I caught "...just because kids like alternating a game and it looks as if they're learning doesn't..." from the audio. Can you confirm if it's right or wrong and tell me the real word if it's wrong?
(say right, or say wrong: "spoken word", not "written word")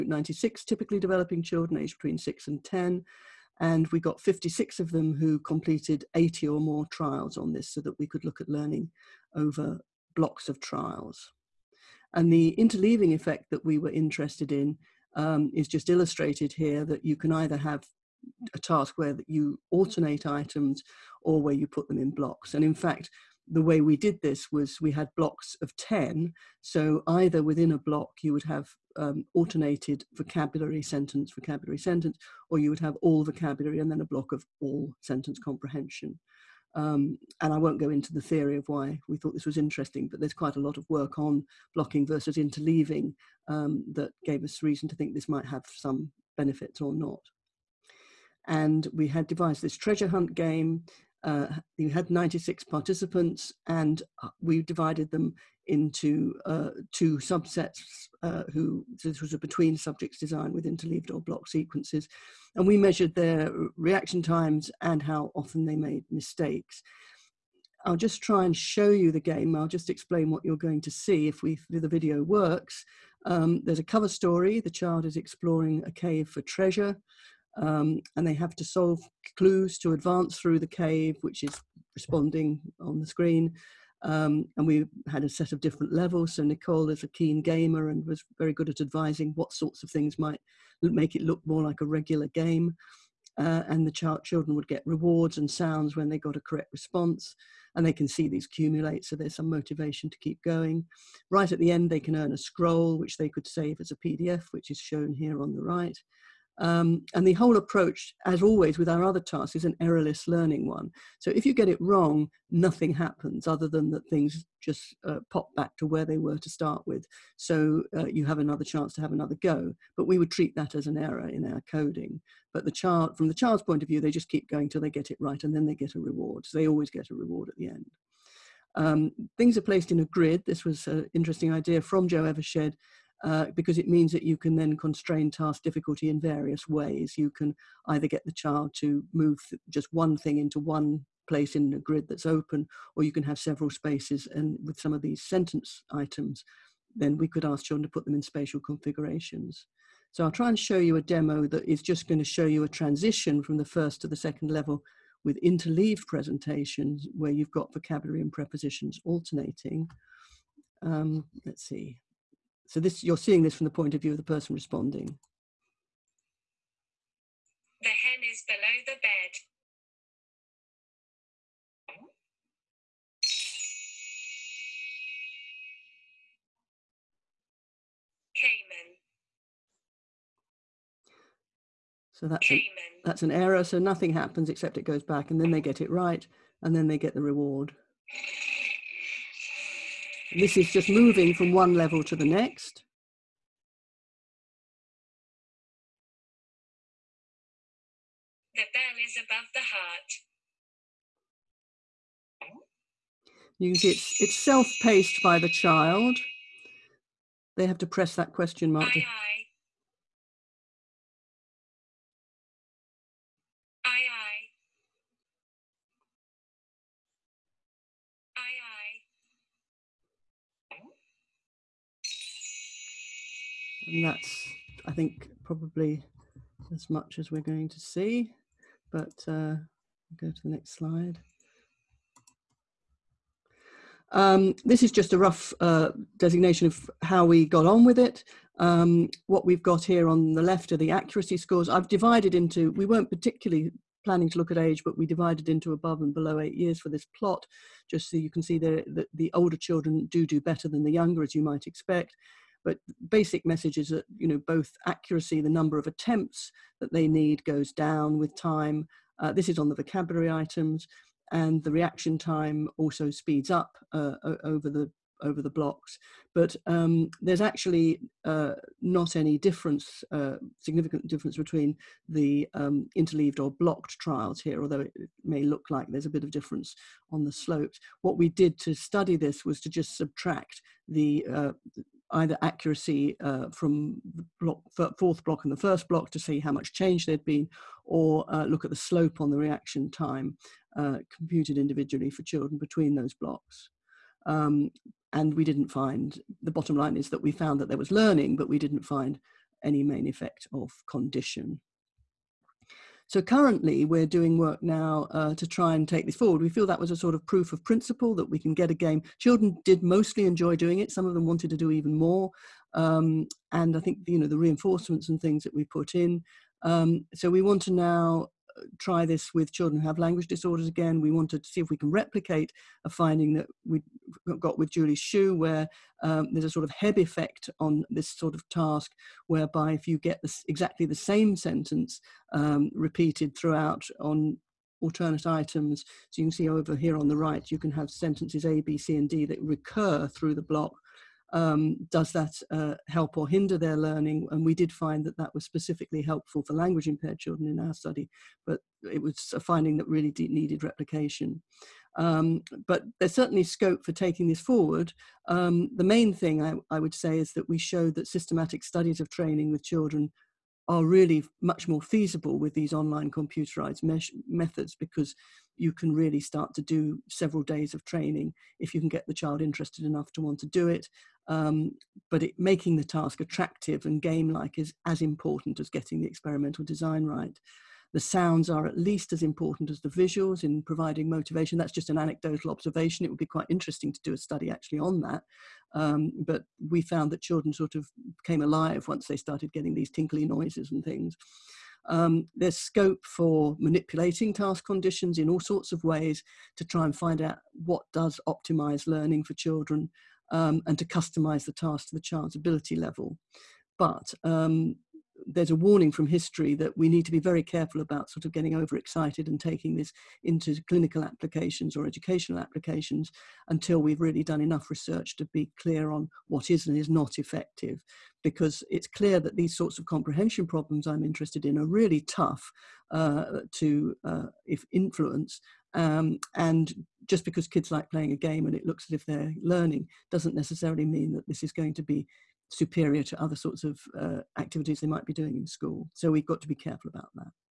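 wrong: "playing", not "alternating".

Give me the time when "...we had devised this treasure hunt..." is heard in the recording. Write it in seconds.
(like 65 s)
48 s.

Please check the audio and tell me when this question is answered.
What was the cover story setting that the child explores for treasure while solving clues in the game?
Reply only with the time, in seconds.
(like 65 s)
75 s.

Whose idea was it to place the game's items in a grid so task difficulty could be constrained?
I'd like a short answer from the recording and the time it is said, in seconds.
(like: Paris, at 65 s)
Jo Evershed, at 132 s.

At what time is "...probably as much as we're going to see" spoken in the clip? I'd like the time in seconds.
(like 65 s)
225 s.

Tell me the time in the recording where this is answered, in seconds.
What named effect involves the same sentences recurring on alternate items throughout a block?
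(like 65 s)
326 s.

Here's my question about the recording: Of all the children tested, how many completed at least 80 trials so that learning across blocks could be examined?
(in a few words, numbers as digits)
56.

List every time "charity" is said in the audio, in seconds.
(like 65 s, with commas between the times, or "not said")
not said.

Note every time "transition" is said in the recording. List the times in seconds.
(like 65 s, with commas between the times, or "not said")
152 s.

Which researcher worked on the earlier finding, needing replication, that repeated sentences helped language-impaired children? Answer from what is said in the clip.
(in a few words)
Julie Hsu.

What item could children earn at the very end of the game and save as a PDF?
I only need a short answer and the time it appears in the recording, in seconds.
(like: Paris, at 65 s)
A scroll, at 102 s.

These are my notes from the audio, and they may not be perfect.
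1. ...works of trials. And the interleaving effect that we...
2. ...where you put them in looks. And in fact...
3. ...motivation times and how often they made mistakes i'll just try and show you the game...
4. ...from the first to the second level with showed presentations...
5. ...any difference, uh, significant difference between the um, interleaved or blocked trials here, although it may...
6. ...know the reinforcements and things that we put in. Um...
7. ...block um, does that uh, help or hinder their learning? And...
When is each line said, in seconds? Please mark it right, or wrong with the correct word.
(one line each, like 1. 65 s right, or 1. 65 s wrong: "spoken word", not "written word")
1. 10 s wrong: "blocks", not "works"
2. 21 s wrong: "blocks", not "looks"
3. 63 s wrong: "reaction", not "motivation"
4. 153 s wrong: "interleaved", not "showed"
5. 269 s right
6. 314 s right
7. 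340 s right.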